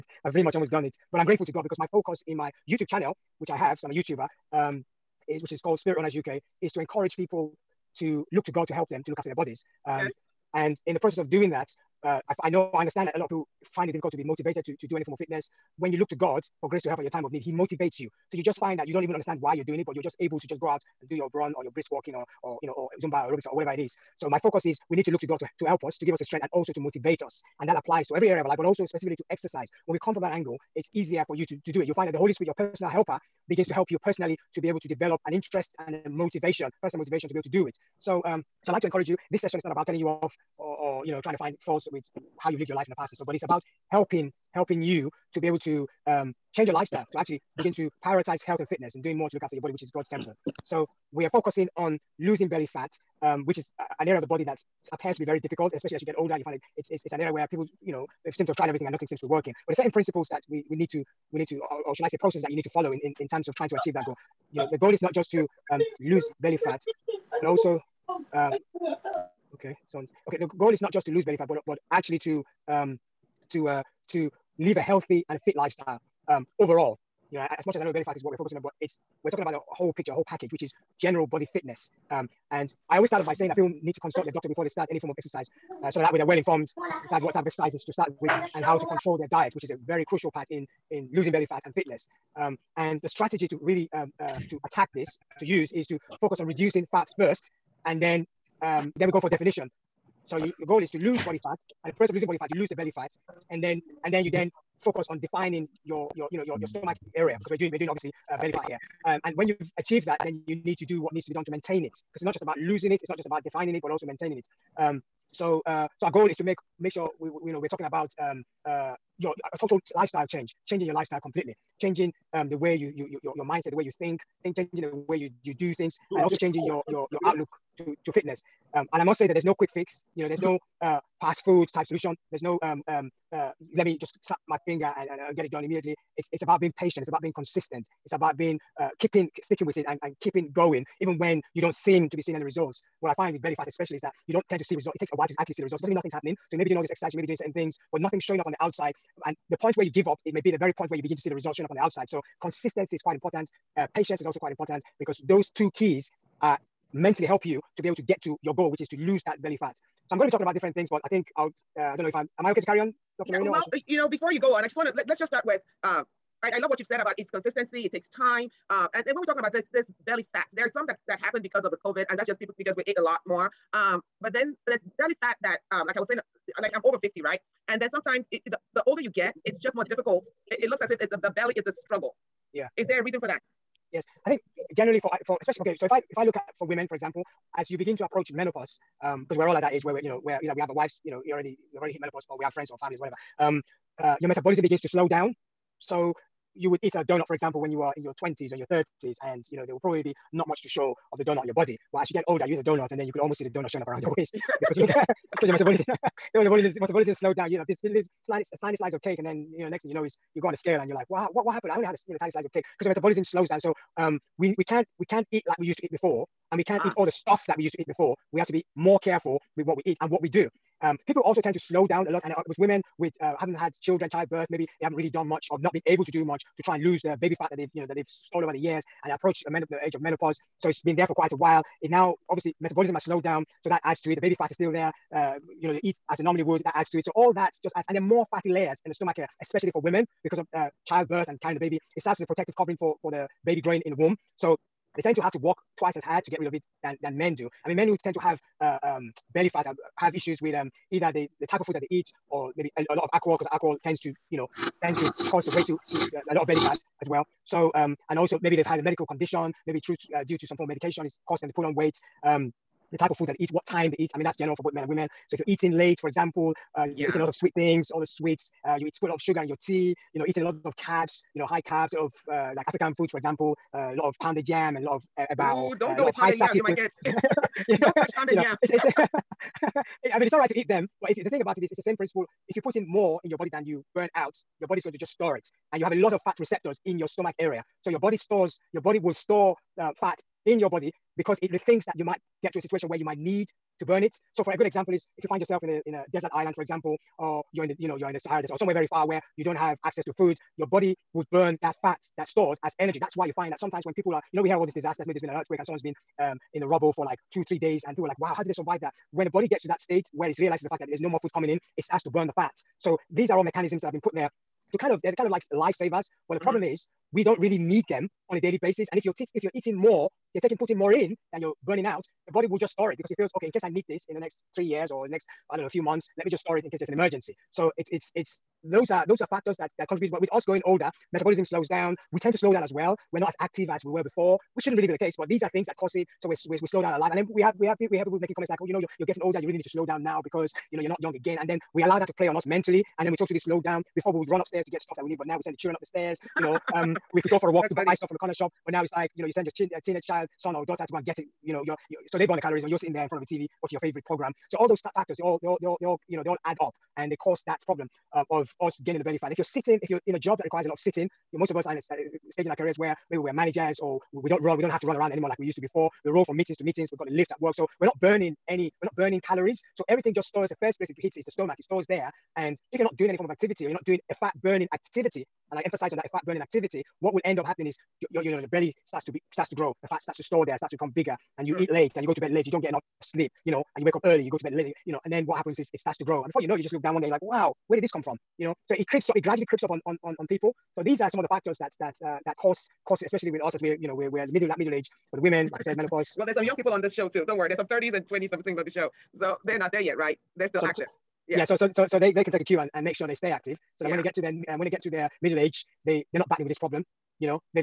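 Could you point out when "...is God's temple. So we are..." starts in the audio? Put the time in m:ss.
0:49.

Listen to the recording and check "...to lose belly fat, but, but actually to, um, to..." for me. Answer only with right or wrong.
right.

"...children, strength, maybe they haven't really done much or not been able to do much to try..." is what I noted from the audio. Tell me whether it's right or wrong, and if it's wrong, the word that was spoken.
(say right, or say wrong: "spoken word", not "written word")
wrong: "childbirth", not "strength".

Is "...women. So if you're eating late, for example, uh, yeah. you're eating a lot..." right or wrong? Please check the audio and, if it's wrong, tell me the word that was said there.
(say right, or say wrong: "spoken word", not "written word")
right.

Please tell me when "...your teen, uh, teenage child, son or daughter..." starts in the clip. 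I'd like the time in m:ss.
5:49.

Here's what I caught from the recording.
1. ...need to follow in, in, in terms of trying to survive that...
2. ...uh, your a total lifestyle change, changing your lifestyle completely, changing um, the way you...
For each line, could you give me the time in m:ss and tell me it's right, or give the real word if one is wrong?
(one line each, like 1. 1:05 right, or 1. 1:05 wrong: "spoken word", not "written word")
1. 1:02 wrong: "achieve", not "survive"
2. 1:58 right.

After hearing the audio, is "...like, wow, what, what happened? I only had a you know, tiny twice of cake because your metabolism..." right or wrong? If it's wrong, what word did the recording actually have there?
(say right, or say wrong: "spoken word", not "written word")
wrong: "slice", not "twice".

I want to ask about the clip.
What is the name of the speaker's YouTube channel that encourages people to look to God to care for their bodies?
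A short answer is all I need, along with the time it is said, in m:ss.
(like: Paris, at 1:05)
Spirit Runners UK, at 0:05.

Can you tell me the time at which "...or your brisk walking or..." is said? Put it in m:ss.
0:21.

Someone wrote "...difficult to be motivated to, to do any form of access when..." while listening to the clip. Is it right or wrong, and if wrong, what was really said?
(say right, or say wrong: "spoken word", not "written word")
wrong: "fitness", not "access".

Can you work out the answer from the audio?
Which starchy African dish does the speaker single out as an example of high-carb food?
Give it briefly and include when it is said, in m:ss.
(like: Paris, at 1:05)
pounded yam, at 4:34.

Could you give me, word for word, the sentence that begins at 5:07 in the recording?
And people were like, wow, how did they survive that?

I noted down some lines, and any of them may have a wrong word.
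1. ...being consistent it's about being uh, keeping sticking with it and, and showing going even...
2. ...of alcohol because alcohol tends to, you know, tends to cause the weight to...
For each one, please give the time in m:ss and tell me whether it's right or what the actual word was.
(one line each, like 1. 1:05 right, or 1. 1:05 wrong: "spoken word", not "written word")
1. 2:17 wrong: "keeping", not "showing"
2. 4:13 right.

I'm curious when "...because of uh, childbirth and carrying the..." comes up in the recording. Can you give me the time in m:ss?
4:00.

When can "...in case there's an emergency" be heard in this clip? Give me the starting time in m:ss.
5:26.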